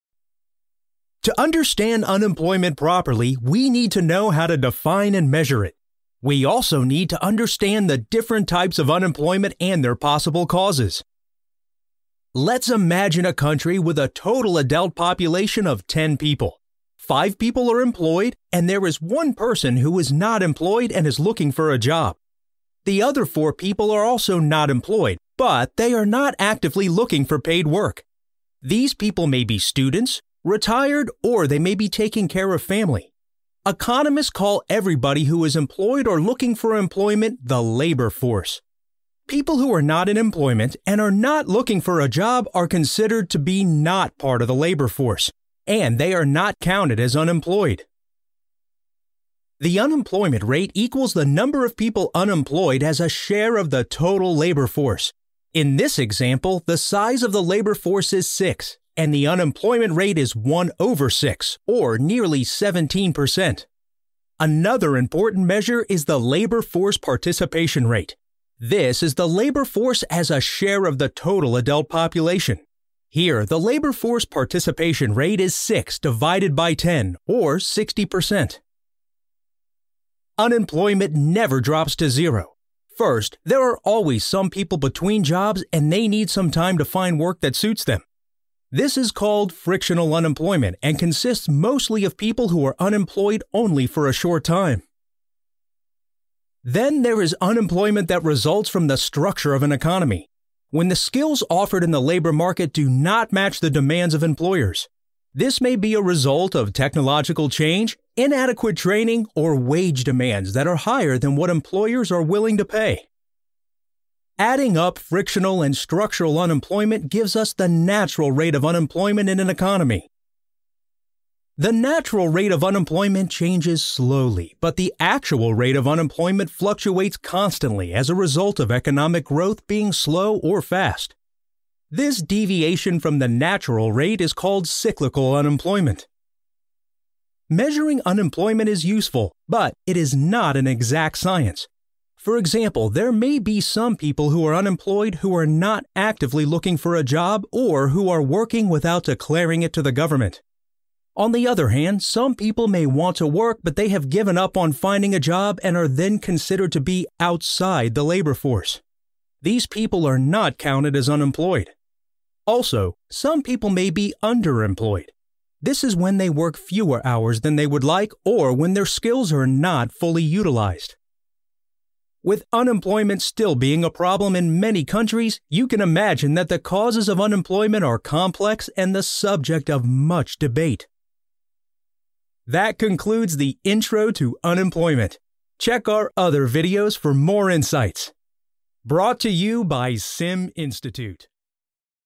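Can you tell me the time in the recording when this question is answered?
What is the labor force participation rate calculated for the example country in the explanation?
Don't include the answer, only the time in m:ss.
1:17.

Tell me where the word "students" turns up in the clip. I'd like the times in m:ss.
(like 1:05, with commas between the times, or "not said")
0:29.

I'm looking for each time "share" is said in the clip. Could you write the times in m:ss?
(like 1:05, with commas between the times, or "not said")
0:53, 1:10.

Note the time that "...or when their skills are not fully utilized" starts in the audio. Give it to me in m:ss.
2:48.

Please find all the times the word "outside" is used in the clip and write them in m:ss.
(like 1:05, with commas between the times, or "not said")
2:37.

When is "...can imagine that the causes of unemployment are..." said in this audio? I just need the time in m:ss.
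2:55.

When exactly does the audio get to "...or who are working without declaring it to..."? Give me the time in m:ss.
2:27.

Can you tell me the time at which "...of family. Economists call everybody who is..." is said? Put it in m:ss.
0:32.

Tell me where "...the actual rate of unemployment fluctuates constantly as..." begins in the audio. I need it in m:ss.
2:04.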